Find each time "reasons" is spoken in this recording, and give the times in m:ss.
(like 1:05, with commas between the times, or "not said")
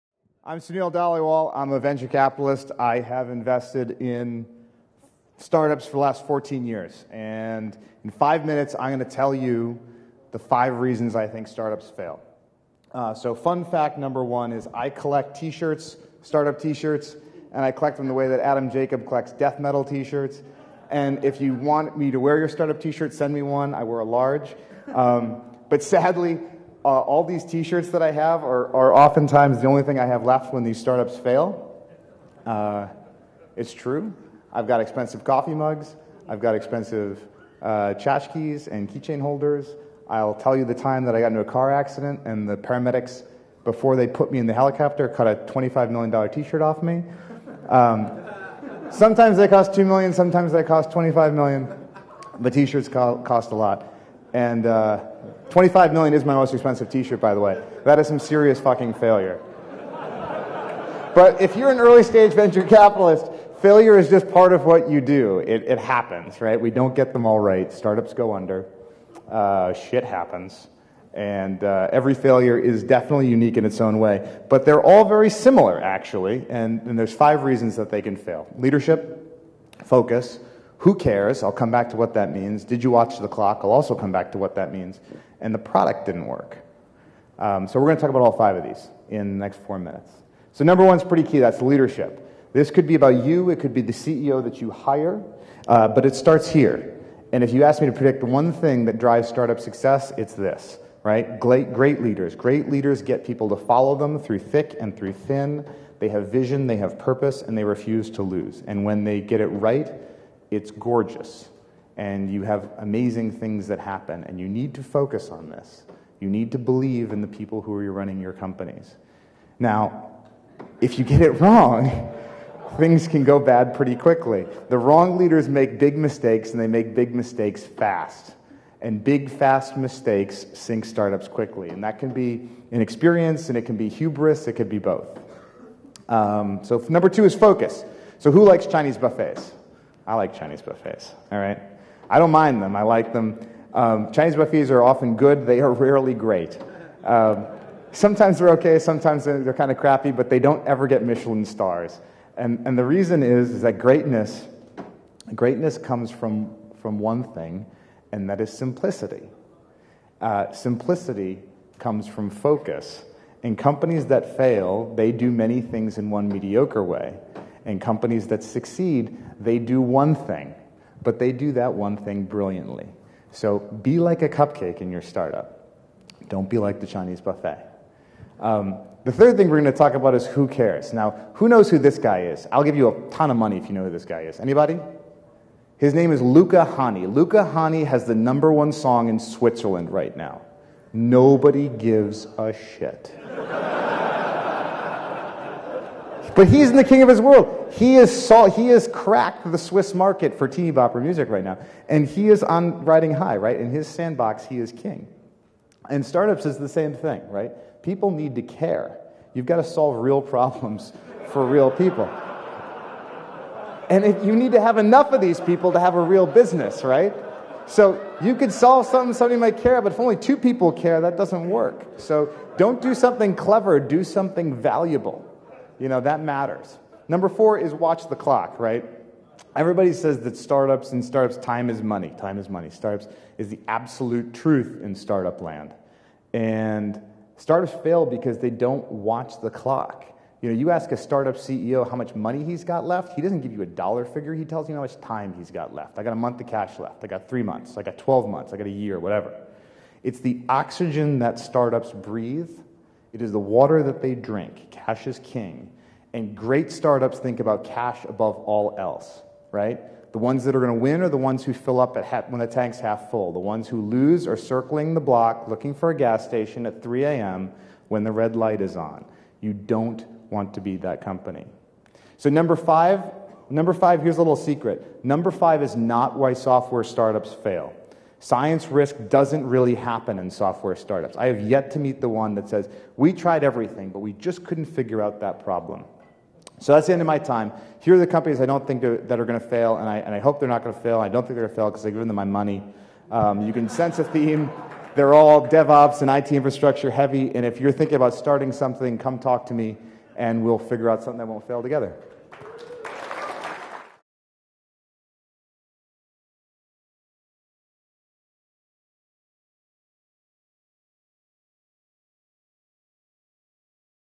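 0:10, 1:17, 2:32.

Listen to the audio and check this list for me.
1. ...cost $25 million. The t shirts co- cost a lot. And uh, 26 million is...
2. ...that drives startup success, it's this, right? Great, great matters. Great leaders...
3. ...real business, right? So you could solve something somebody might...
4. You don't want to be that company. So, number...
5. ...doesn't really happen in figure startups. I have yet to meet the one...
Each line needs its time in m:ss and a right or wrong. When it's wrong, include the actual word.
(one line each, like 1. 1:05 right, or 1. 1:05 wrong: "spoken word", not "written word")
1. 0:50 wrong: "25", not "26"
2. 1:38 wrong: "leaders", not "matters"
3. 3:36 right
4. 4:29 right
5. 4:39 wrong: "software", not "figure".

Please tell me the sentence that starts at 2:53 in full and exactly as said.
So be like a cupcake in your startup.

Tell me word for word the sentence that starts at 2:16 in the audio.
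Um, so, number two is focus.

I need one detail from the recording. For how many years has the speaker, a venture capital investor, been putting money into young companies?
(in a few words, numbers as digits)
14 years.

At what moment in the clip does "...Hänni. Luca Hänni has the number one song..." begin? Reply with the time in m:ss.
3:06.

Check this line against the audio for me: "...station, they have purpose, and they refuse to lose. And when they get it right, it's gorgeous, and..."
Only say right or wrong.
wrong.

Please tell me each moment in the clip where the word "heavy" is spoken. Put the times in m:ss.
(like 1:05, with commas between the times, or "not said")
4:56.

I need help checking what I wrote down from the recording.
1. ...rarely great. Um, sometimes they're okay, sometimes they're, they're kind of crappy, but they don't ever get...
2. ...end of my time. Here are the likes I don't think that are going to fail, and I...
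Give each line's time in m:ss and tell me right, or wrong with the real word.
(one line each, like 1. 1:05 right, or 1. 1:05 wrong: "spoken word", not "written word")
1. 2:25 right
2. 4:46 wrong: "companies", not "likes".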